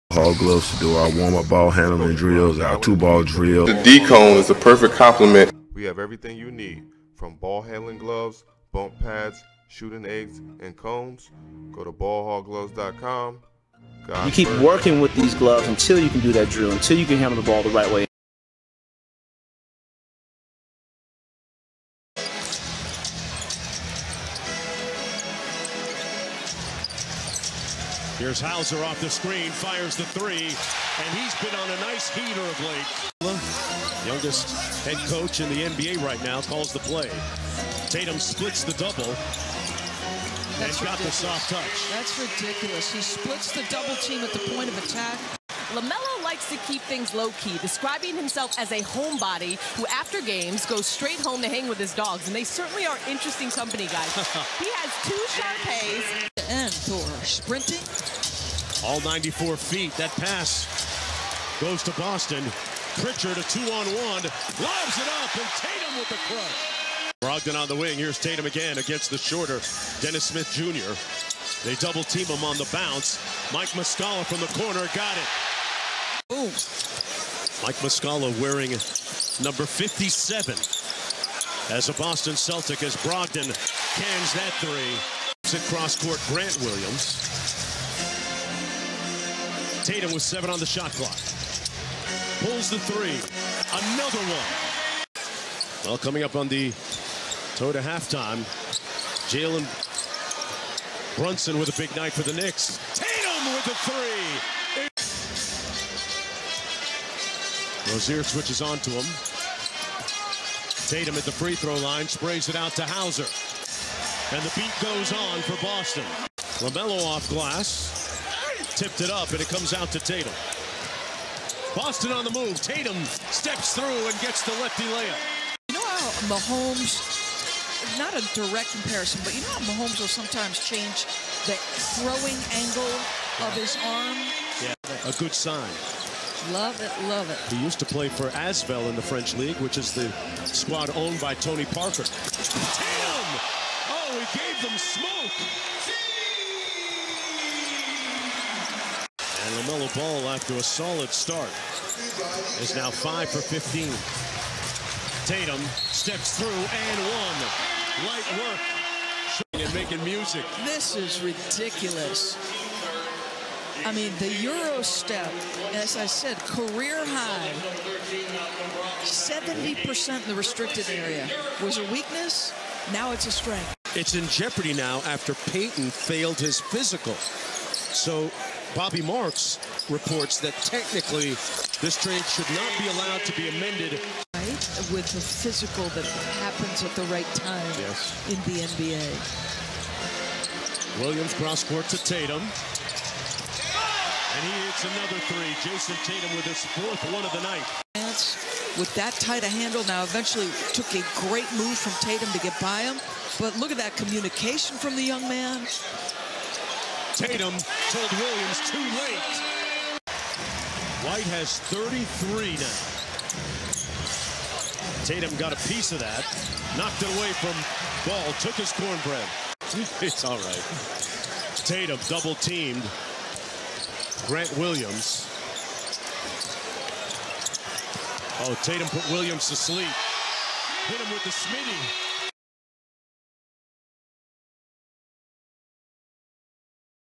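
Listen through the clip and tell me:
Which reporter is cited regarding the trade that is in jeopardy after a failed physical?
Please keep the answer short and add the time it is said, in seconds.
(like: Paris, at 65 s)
Bobby Marks, at 178 s.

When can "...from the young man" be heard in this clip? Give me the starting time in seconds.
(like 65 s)
204 s.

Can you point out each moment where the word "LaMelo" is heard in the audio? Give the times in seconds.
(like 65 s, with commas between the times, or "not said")
45 s, 116 s, 149 s.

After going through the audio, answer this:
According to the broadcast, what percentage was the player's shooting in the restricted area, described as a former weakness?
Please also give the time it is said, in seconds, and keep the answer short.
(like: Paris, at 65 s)
70%, at 169 s.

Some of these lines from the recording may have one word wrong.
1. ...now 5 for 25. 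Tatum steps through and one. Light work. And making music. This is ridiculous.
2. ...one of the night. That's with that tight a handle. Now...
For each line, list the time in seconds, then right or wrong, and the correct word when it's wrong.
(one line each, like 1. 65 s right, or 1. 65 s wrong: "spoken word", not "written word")
1. 152 s wrong: "15", not "25"
2. 197 s right.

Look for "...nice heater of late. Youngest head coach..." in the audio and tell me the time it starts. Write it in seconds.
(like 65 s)
31 s.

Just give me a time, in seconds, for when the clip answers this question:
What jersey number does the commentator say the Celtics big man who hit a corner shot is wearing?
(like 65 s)
79 s.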